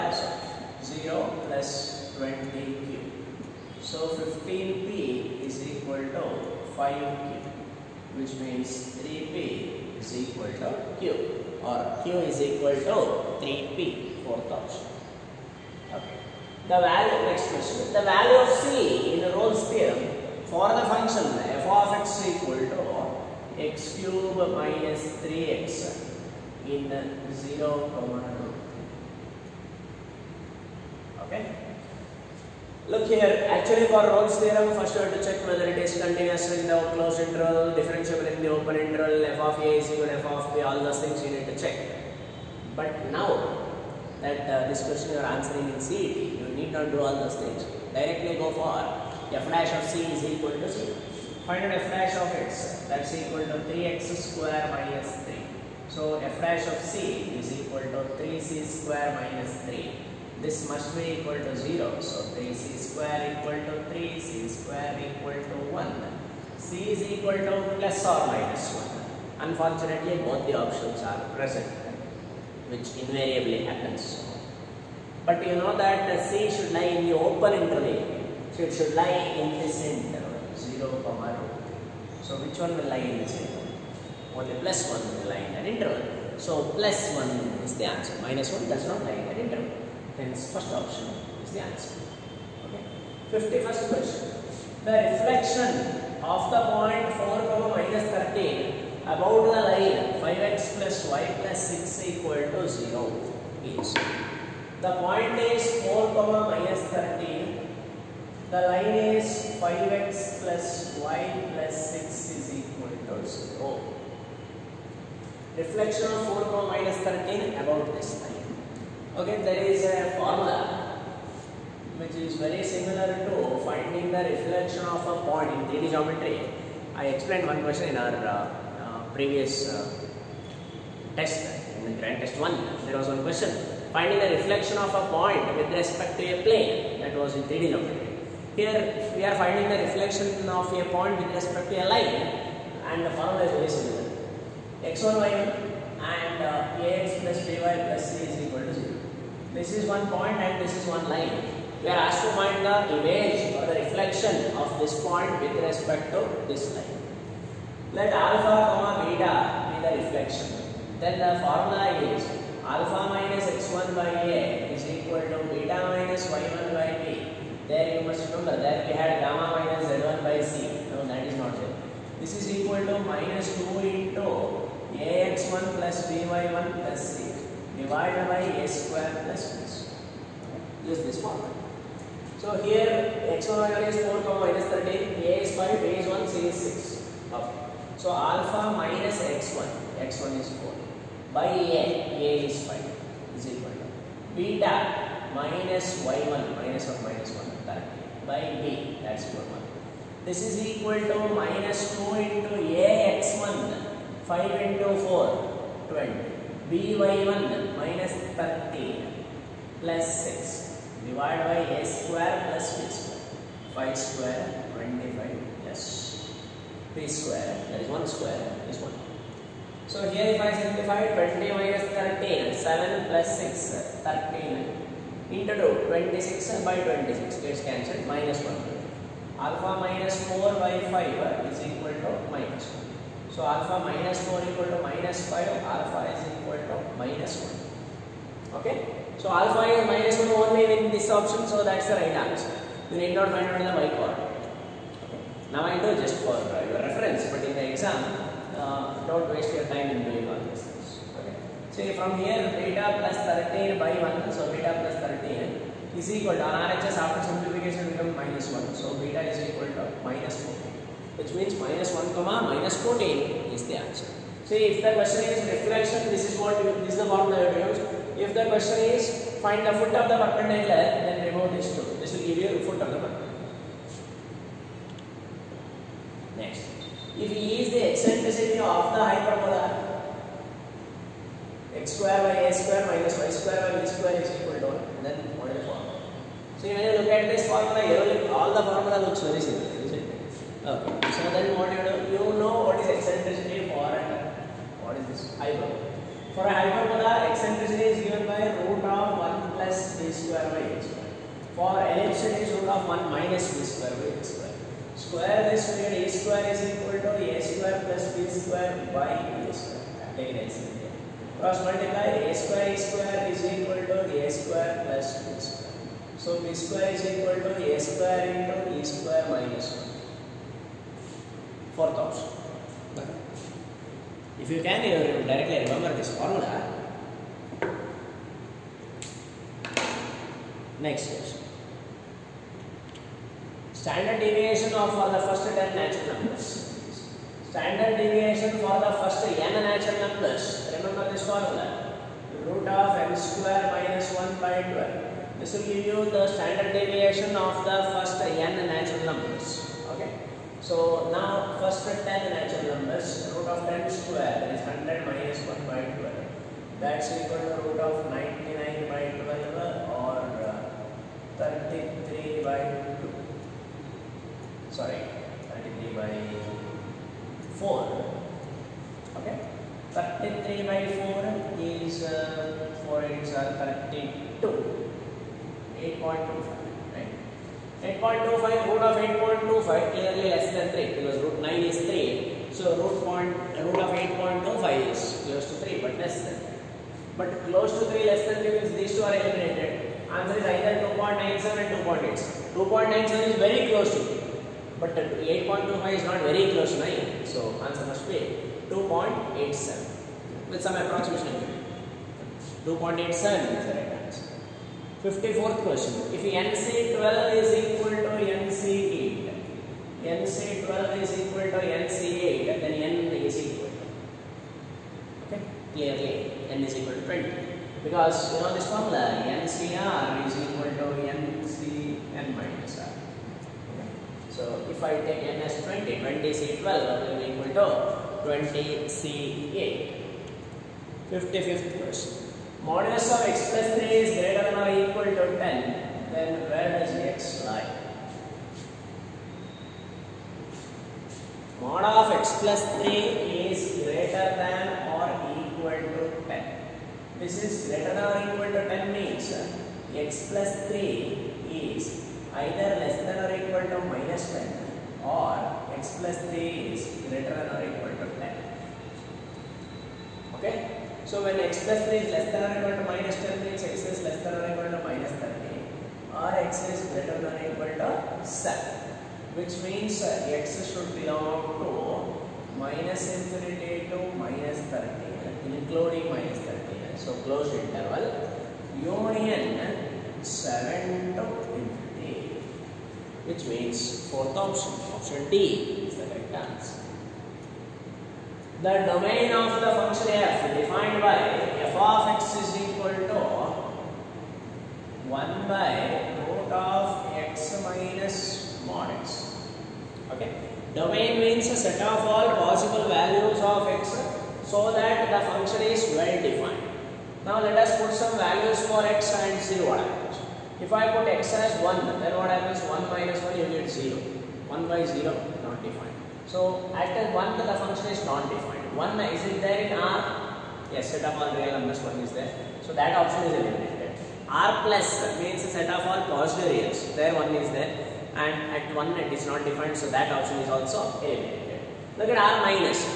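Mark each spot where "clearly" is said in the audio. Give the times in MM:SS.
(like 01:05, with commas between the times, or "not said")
06:19, 06:55.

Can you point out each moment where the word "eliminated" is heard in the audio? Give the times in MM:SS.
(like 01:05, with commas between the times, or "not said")
06:29, 08:43, 08:51.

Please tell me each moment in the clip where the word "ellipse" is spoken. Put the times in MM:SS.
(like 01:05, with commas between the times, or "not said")
05:01.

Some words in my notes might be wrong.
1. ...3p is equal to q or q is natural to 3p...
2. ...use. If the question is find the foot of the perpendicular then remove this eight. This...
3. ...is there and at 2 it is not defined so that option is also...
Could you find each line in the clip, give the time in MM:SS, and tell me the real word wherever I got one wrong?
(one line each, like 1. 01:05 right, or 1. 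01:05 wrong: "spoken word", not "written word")
1. 00:08 wrong: "equal", not "natural"
2. 04:27 wrong: "two", not "eight"
3. 08:47 wrong: "1", not "2".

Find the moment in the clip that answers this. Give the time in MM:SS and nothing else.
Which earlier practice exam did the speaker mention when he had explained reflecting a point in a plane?
02:12.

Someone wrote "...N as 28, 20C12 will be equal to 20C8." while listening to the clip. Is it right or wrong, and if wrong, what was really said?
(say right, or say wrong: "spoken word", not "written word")
wrong: "20", not "28".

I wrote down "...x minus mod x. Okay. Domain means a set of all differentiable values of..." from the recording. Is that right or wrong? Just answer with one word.
wrong.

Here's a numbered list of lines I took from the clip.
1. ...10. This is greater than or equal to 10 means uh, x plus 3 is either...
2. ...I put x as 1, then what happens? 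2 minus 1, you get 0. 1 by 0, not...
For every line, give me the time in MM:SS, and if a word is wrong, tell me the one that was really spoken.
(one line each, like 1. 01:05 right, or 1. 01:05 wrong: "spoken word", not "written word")
1. 07:26 right
2. 08:30 wrong: "1", not "2".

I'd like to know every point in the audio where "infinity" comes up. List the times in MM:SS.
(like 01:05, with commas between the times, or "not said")
07:53, 08:01.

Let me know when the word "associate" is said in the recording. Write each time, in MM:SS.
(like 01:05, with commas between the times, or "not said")
not said.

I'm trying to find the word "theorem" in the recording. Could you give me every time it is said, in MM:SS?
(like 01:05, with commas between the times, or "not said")
00:19, 00:34.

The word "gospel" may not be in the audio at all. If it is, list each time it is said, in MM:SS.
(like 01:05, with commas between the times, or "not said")
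not said.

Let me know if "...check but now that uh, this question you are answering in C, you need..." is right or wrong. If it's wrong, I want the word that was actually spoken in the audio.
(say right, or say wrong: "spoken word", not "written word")
right.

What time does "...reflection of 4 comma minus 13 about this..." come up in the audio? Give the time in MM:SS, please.
01:55.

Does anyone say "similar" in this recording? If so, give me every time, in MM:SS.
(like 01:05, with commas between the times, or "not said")
02:02, 02:23.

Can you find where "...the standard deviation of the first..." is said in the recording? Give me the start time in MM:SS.
05:46.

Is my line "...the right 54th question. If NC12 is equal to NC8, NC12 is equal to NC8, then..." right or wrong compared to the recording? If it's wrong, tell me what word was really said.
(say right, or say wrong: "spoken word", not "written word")
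right.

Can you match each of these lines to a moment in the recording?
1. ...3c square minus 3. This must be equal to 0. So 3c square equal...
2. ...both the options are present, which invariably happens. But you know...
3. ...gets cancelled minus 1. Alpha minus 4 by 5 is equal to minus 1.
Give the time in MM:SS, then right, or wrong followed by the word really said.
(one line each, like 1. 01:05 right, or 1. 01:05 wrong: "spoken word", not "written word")
1. 00:58 right
2. 01:10 right
3. 03:47 right.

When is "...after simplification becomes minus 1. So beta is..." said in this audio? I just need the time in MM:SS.
04:17.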